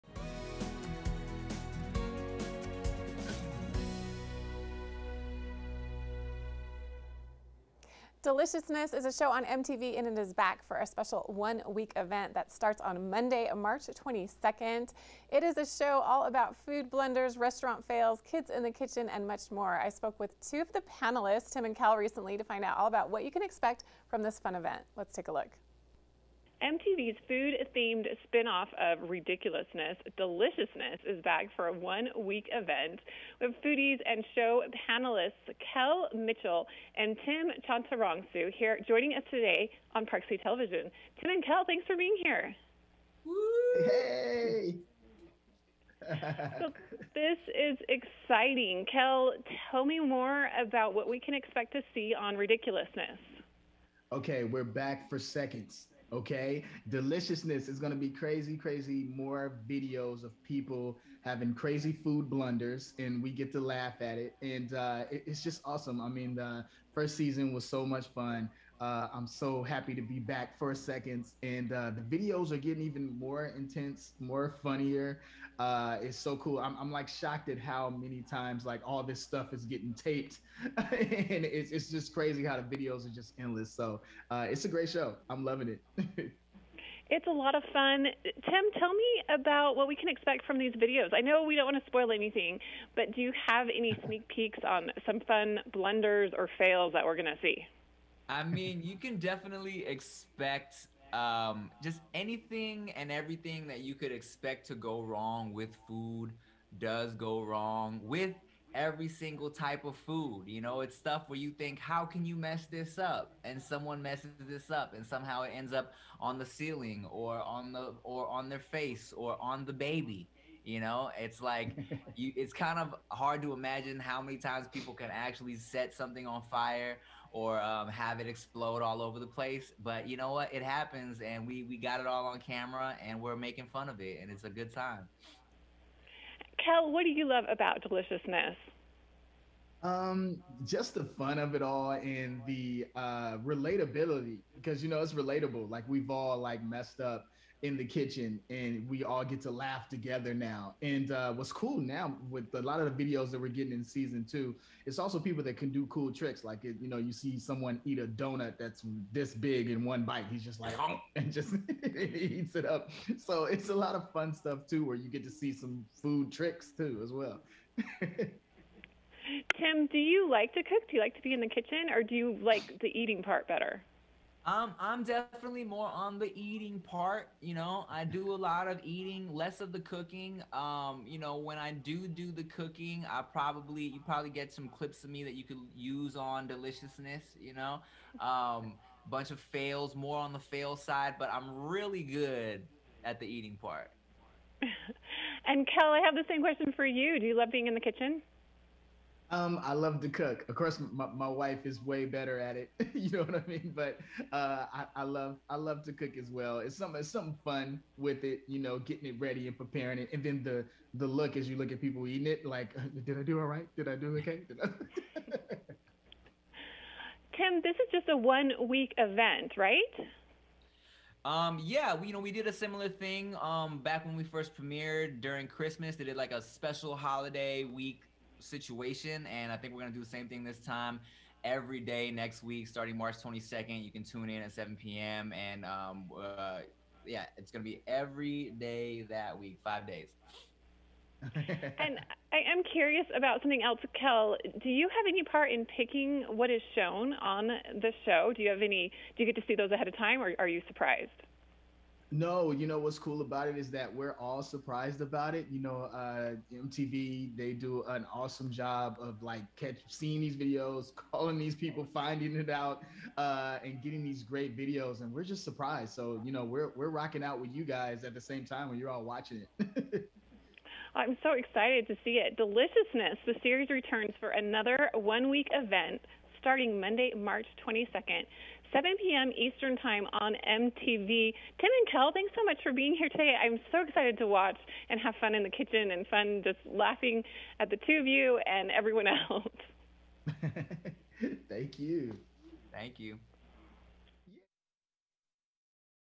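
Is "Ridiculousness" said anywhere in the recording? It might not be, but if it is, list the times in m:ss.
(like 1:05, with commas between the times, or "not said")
0:29, 0:52.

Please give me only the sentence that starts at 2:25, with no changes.
Like we've all like messed up in the kitchen and we all get to laugh together now.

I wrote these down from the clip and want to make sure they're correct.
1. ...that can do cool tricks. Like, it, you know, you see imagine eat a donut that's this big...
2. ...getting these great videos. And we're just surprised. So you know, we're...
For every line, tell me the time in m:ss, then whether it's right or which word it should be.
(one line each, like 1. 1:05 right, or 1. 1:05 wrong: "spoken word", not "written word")
1. 2:35 wrong: "someone", not "imagine"
2. 4:23 right.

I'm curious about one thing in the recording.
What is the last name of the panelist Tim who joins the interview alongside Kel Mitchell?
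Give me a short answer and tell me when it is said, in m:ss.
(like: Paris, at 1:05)
Chantarangsu, at 0:37.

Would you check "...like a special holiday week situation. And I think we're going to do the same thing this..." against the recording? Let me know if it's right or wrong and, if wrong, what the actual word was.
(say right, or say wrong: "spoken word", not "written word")
right.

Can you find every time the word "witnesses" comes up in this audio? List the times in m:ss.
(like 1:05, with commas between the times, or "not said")
not said.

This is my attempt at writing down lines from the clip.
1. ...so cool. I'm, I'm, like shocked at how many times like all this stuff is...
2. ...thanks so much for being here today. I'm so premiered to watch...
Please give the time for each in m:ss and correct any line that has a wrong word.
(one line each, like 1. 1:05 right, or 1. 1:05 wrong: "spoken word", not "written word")
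1. 1:16 right
2. 4:42 wrong: "excited", not "premiered".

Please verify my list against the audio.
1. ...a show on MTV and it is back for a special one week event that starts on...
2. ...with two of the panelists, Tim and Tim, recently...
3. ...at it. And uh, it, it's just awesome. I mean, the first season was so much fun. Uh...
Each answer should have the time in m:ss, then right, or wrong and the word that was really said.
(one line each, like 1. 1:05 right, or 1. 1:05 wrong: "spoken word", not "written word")
1. 0:09 right
2. 0:20 wrong: "Kel", not "Tim"
3. 1:04 right.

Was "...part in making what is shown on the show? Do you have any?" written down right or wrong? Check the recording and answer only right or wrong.
wrong.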